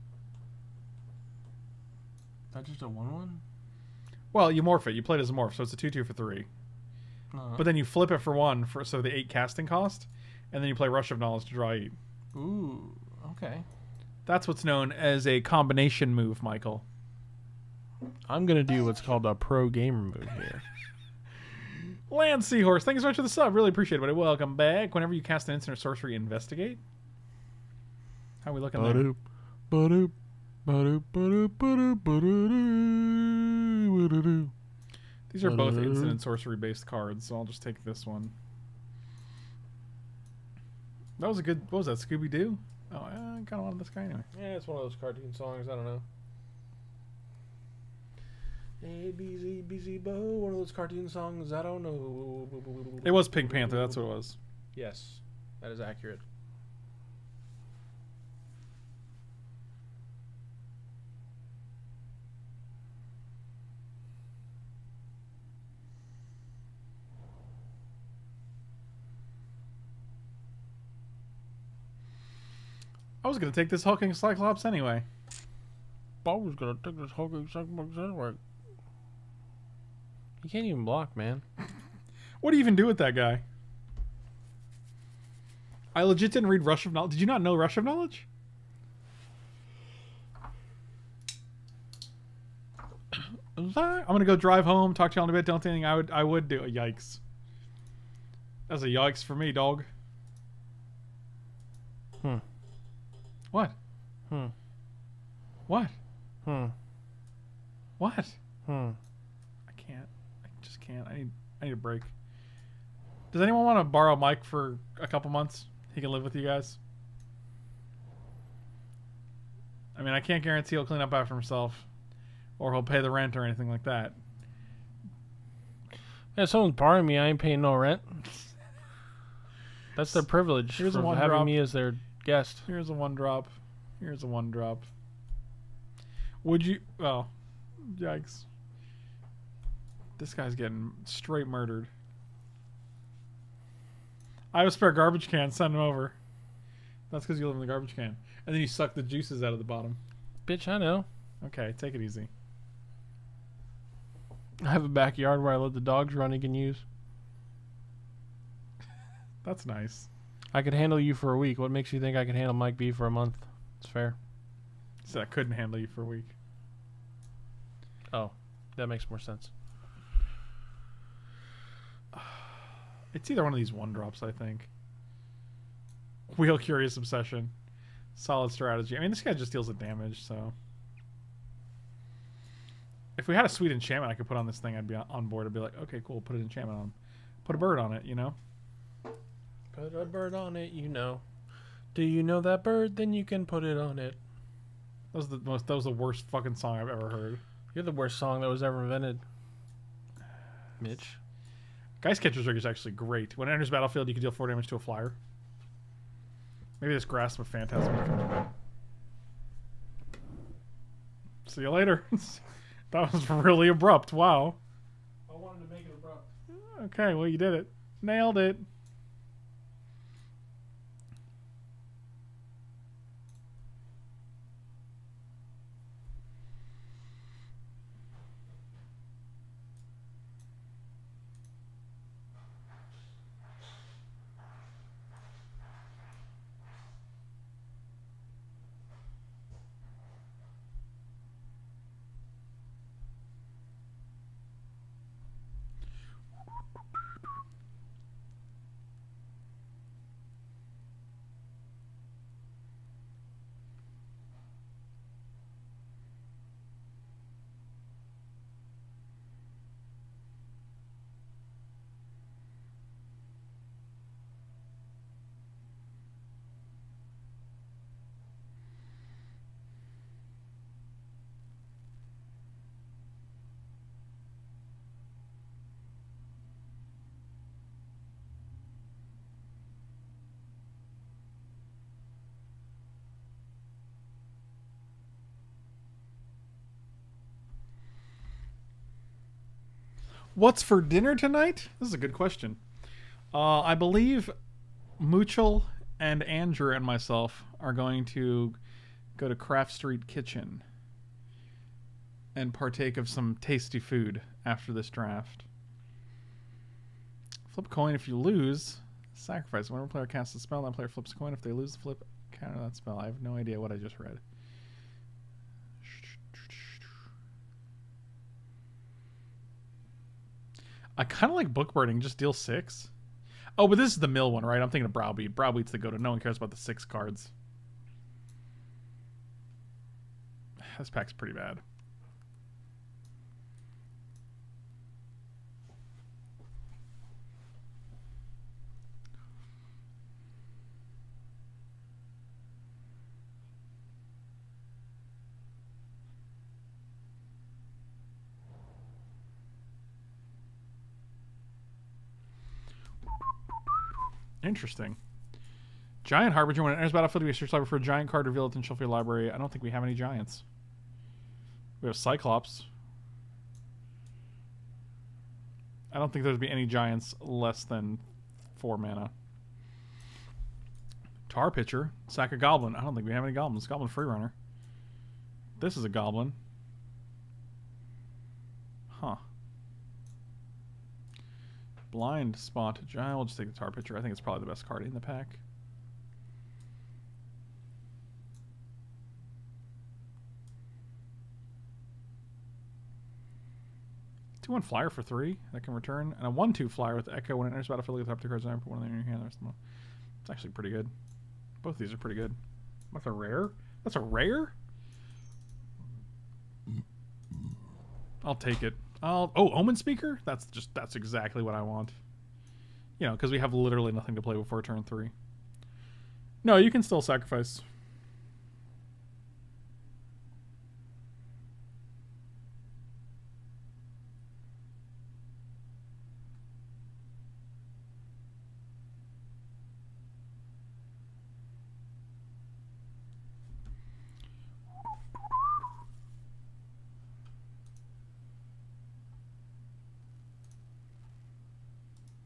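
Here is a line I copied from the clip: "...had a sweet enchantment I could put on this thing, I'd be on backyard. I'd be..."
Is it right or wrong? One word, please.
wrong.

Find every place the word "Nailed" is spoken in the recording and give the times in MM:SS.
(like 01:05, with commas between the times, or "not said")
03:38.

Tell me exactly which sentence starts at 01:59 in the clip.
I mean, I can't guarantee he'll clean up after himself, or he'll pay the rent or anything like that.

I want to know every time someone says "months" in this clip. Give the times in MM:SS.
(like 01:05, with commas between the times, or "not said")
01:55, 02:43.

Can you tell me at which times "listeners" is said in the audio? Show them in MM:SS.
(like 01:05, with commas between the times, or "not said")
not said.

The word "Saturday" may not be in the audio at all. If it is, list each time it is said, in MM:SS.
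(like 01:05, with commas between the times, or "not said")
not said.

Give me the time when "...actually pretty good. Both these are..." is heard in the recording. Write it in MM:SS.
06:40.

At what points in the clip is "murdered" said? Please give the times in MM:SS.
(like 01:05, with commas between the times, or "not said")
02:21.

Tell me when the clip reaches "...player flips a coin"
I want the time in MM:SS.
05:10.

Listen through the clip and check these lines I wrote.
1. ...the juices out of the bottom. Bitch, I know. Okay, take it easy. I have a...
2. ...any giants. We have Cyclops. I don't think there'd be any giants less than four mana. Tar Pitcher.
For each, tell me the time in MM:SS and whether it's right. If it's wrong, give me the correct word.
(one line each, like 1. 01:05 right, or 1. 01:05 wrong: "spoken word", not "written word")
1. 02:28 right
2. 05:59 right.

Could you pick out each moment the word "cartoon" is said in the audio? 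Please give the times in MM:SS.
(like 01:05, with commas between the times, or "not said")
00:44, 00:50.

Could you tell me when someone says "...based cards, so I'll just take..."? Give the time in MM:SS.
00:36.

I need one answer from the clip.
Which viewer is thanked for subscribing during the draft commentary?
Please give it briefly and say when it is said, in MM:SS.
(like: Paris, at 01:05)
Land Seahorse, at 00:22.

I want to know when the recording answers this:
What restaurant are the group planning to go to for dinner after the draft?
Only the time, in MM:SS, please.
04:59.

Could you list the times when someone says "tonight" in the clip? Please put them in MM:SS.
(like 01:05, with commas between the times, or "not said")
04:51.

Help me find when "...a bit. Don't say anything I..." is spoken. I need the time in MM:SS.
01:35.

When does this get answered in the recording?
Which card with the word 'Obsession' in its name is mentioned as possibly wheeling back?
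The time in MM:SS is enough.
02:56.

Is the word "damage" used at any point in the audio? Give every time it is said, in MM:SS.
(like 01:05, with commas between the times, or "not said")
02:59, 03:24.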